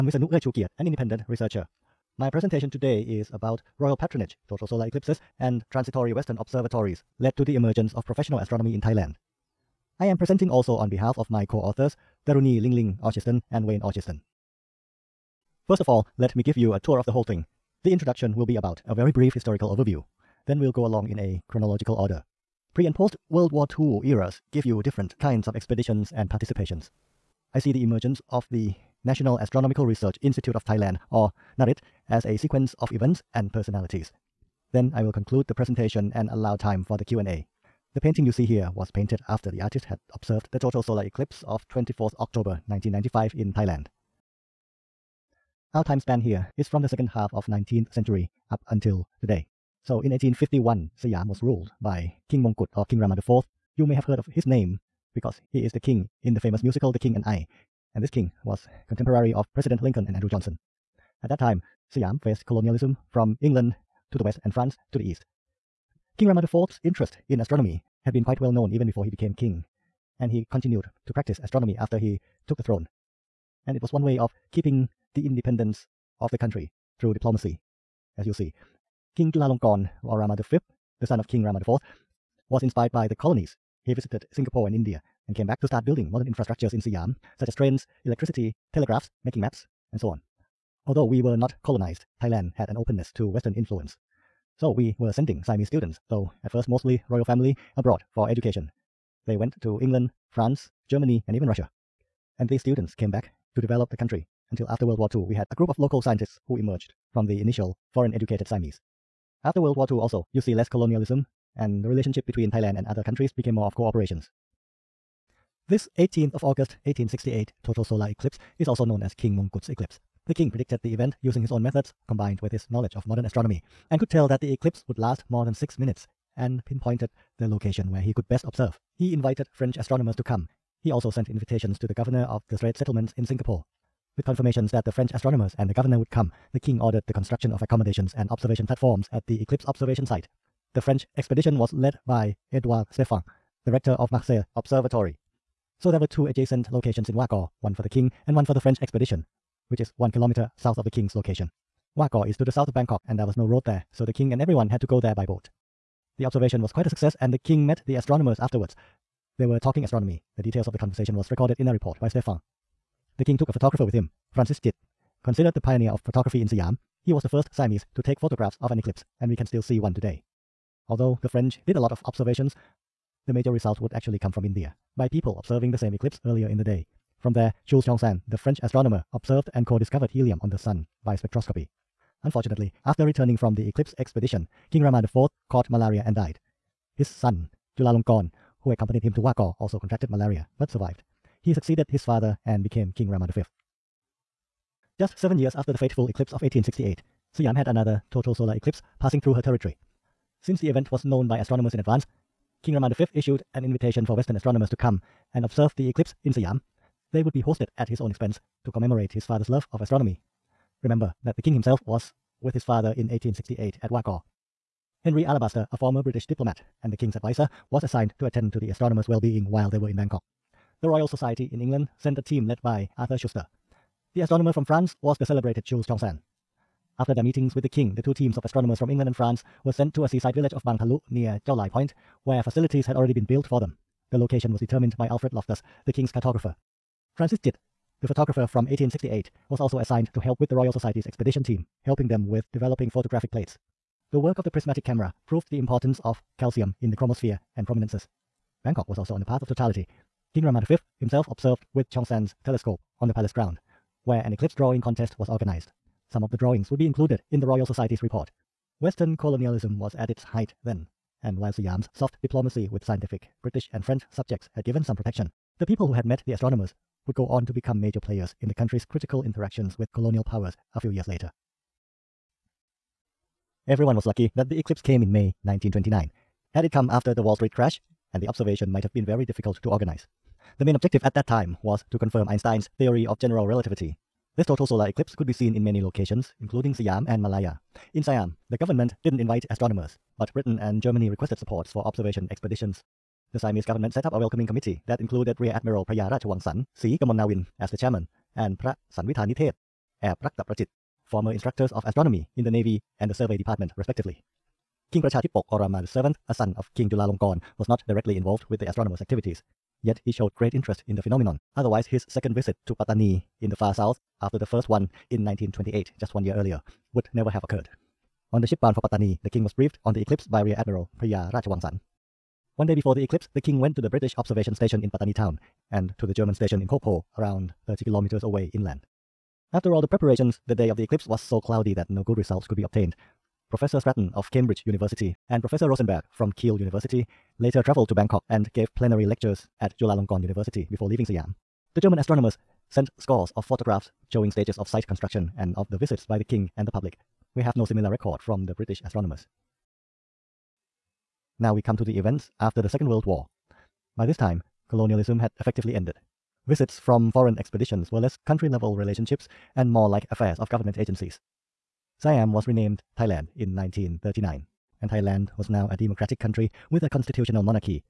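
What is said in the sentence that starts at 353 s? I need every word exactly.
By this time, colonialism had effectively ended.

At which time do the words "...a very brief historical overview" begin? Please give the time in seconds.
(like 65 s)
18 s.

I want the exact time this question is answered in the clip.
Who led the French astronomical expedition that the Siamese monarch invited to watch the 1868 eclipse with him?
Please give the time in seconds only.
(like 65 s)
142 s.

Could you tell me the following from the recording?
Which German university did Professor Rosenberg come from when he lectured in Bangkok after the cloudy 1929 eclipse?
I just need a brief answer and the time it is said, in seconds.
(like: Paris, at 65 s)
Kiel University, at 336 s.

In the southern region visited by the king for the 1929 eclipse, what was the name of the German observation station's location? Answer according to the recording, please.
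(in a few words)
Kokpo.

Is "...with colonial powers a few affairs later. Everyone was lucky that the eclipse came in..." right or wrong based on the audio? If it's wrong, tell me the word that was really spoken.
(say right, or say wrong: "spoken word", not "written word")
wrong: "years", not "affairs".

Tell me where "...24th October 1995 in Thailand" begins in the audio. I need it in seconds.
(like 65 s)
41 s.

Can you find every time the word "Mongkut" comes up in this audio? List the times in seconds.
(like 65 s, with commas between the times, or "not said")
52 s, 119 s.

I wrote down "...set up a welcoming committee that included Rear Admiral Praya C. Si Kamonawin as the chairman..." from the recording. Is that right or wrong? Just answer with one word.
right.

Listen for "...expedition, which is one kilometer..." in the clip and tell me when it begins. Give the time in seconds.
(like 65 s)
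148 s.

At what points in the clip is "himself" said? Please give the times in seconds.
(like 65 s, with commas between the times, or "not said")
211 s, 250 s.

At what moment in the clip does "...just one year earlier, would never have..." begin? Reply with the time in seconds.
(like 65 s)
315 s.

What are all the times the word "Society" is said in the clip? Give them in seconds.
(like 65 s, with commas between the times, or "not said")
221 s, 240 s, 257 s.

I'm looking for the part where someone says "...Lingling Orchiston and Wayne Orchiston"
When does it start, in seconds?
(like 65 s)
12 s.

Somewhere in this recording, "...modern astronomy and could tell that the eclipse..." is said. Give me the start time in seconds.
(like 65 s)
123 s.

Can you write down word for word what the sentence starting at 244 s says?
The work of the prismatic camera proved the importance of calcium in the chromosphere and prominences.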